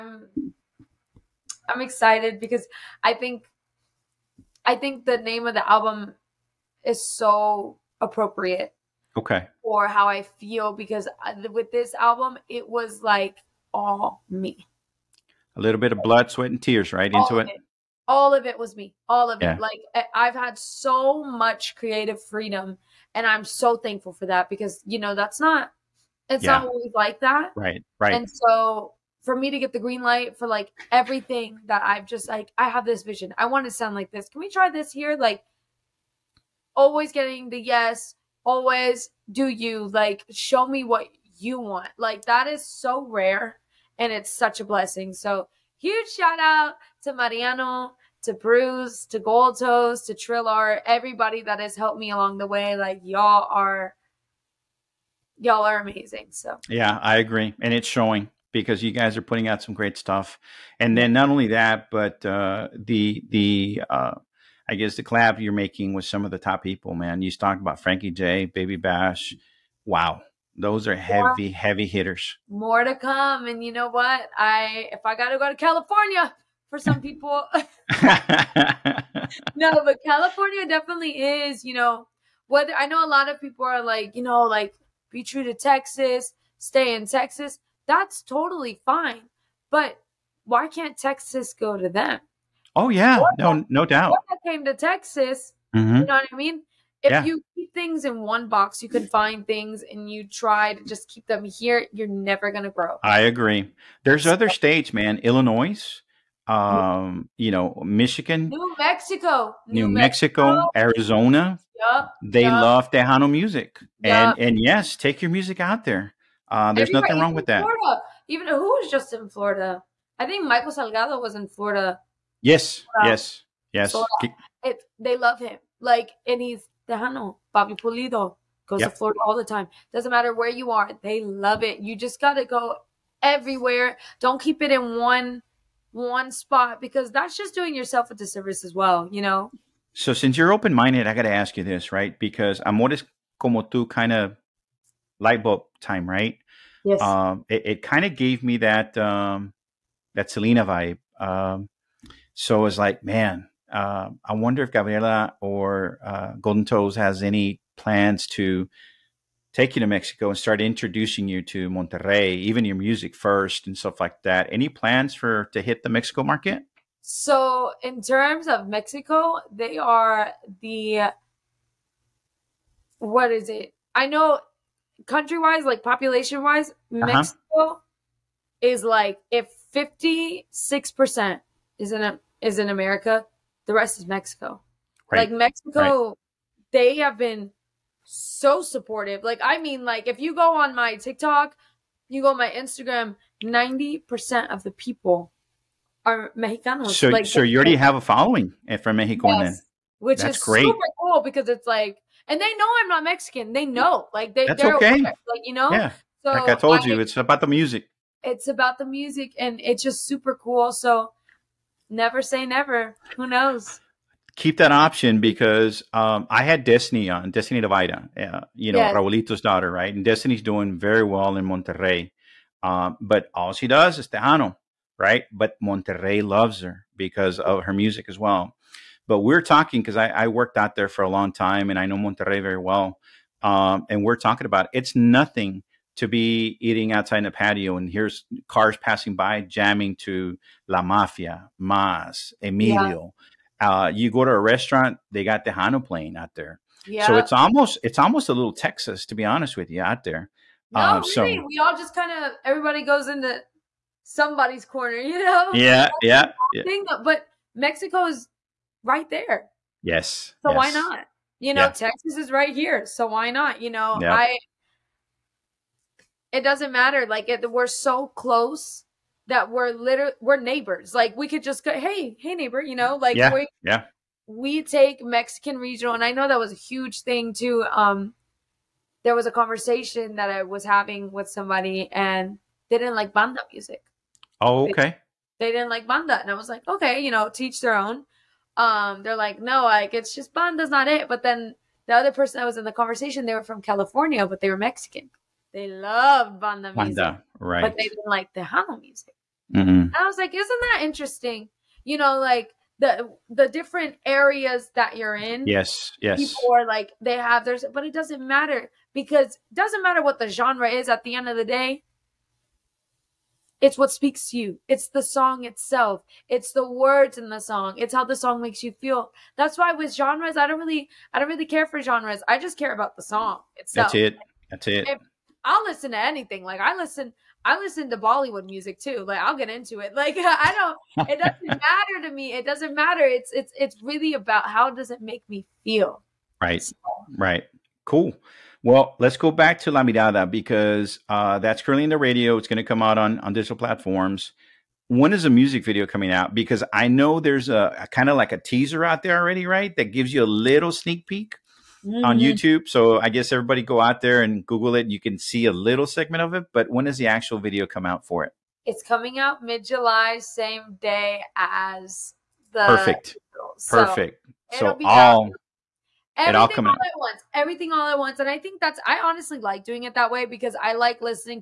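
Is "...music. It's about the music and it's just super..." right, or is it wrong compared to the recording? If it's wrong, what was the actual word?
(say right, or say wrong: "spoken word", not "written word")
right.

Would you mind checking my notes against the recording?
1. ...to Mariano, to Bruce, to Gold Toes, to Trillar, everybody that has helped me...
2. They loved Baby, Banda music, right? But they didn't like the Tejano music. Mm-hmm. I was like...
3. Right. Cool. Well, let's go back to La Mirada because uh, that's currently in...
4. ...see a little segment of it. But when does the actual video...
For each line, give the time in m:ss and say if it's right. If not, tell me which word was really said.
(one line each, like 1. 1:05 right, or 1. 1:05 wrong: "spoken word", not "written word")
1. 0:47 right
2. 4:55 wrong: "Banda", not "Baby"
3. 5:37 right
4. 5:55 right.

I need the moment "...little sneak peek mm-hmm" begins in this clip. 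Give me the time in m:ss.
5:50.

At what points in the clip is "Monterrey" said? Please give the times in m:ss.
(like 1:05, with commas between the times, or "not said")
2:41, 3:41, 3:45, 3:51.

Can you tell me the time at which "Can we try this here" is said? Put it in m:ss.
0:34.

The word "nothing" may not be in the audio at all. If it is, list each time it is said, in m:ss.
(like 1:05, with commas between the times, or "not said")
1:57, 3:54.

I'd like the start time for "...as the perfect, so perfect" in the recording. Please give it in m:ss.
6:01.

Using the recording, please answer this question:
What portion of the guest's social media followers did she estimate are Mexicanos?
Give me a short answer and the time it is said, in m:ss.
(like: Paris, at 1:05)
90%, at 3:13.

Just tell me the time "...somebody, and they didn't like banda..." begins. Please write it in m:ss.
4:41.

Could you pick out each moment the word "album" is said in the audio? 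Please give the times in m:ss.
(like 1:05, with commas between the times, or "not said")
0:05, 0:11.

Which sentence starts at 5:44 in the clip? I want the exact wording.
When is the music video coming out?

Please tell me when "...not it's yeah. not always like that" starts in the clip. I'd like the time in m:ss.
0:25.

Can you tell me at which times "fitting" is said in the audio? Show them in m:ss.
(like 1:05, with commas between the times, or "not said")
not said.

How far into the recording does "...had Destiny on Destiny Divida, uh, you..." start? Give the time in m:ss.
3:36.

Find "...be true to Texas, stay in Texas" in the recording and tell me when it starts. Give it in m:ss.
1:25.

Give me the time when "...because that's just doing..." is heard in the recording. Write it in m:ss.
2:16.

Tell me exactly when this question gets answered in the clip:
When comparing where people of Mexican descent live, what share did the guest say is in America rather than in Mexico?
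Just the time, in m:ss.
2:59.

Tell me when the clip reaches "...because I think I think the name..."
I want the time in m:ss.
0:02.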